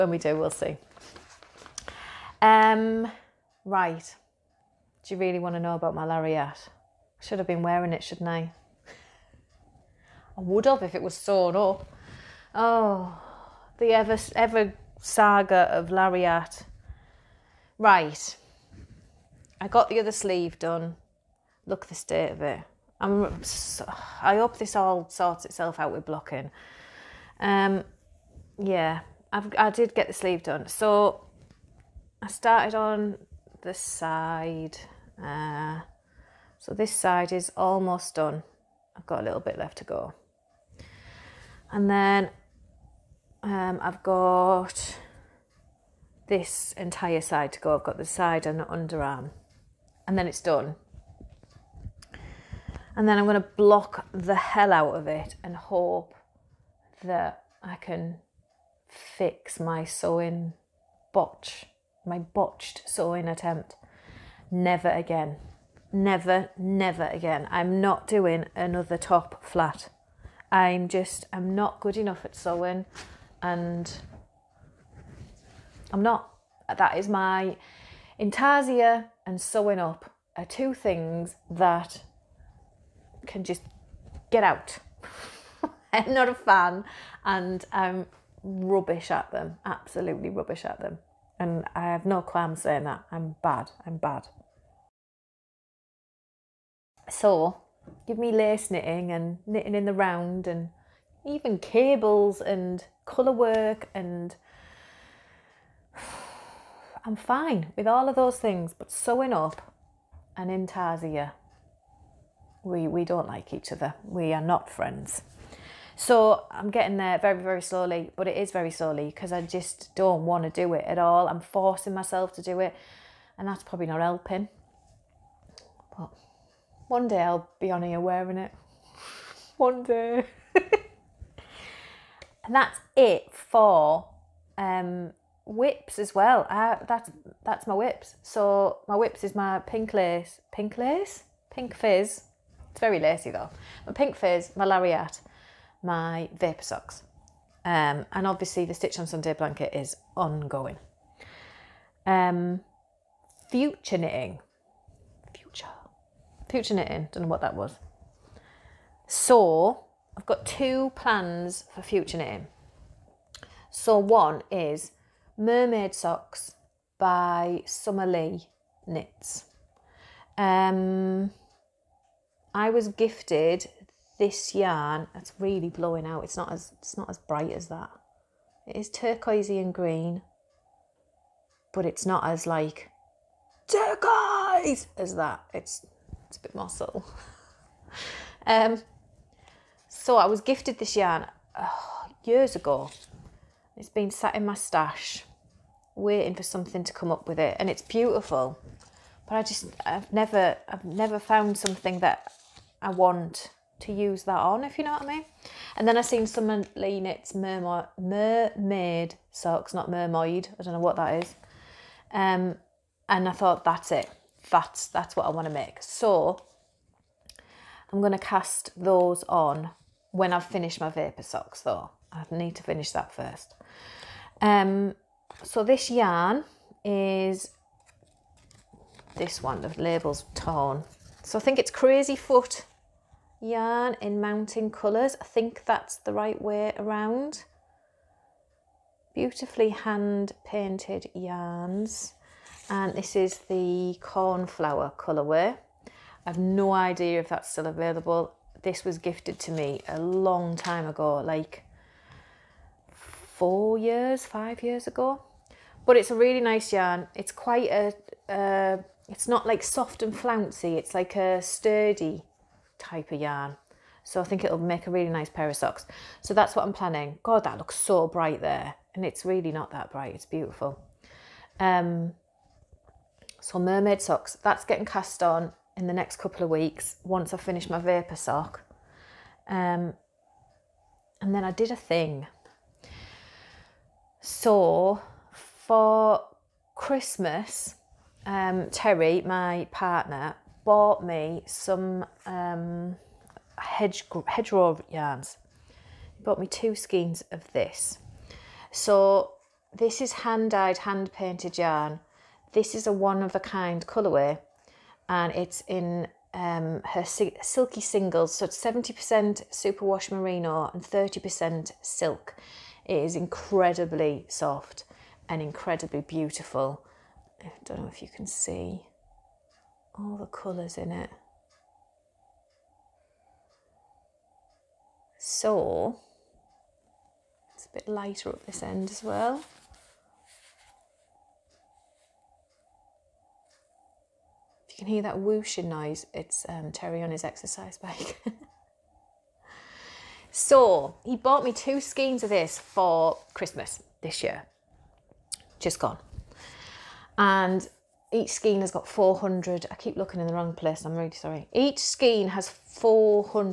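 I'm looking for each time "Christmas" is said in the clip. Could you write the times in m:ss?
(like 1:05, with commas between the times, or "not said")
4:46, 5:43.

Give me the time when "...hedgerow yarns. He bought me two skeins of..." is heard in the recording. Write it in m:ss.
4:54.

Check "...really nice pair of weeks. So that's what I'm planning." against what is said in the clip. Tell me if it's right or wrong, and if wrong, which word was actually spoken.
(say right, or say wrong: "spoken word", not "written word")
wrong: "socks", not "weeks".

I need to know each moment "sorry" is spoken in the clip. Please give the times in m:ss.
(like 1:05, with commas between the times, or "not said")
5:51.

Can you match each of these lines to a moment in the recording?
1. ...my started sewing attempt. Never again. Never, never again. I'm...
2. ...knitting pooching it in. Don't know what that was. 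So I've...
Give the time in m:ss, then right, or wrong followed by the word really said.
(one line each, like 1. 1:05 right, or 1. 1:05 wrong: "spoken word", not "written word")
1. 1:02 wrong: "botched", not "started"
2. 2:33 right.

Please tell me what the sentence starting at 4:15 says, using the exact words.
But it's a really nice yarn.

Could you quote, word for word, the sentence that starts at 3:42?
I need to finish that first.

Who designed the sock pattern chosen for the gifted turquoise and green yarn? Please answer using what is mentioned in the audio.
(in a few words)
Summer Lee Knits.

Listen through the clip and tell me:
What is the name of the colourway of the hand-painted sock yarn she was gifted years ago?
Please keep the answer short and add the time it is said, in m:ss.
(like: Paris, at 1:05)
Cornflower, at 4:03.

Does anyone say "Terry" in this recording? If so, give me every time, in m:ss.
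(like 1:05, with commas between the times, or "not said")
4:48, 5:36.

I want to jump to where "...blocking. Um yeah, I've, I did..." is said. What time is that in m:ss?
0:26.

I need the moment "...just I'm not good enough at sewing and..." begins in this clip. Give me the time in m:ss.
1:10.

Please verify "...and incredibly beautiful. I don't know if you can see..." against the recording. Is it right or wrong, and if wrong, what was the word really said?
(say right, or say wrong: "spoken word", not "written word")
right.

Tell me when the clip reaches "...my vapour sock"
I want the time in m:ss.
4:37.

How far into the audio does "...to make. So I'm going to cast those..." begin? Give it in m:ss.
3:35.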